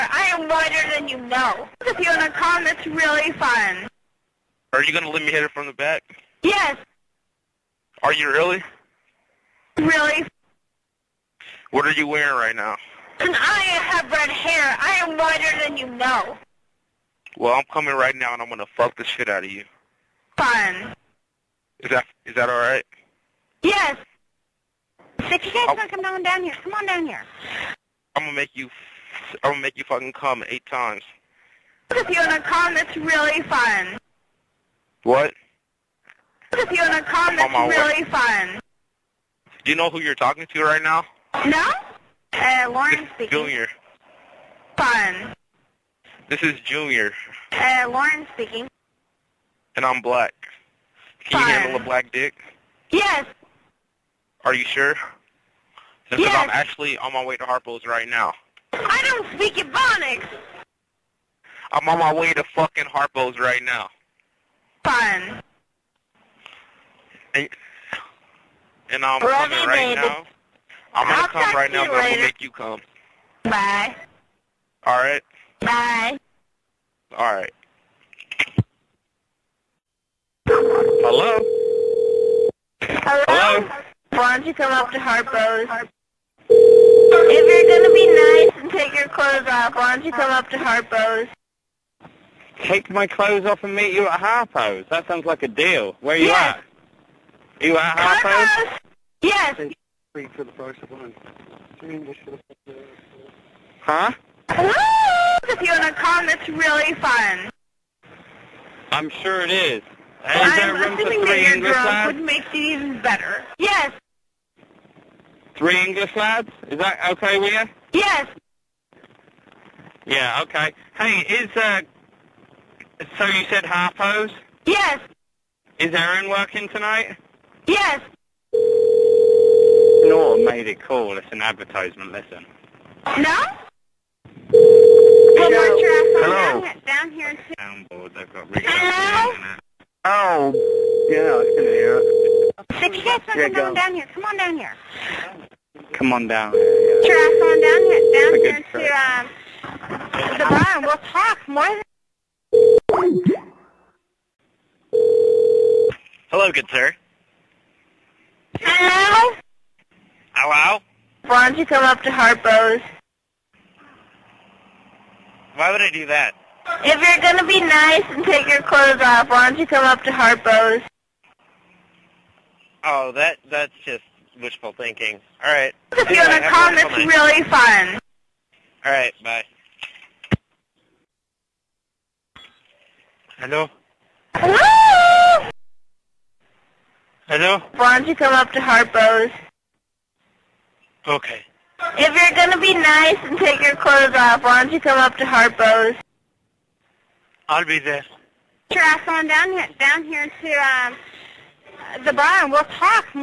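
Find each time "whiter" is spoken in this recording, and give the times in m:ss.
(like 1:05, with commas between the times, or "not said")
0:00, 0:15.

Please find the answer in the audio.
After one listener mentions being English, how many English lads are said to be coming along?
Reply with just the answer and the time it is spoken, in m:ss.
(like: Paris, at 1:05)
3, at 1:55.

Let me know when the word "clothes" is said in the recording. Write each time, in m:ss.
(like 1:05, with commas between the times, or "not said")
1:29, 1:33, 2:48, 3:13.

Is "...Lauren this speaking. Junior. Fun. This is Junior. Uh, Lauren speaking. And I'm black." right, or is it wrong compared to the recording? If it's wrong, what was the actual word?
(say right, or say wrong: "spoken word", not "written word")
right.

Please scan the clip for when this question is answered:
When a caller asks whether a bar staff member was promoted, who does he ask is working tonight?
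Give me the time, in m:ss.
2:05.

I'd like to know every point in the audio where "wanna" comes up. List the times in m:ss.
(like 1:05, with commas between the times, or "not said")
0:25, 0:32, 0:36.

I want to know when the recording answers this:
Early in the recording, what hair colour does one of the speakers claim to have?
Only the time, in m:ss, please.
0:14.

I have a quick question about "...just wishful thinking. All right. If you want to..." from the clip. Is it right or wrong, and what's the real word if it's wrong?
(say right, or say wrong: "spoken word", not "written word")
right.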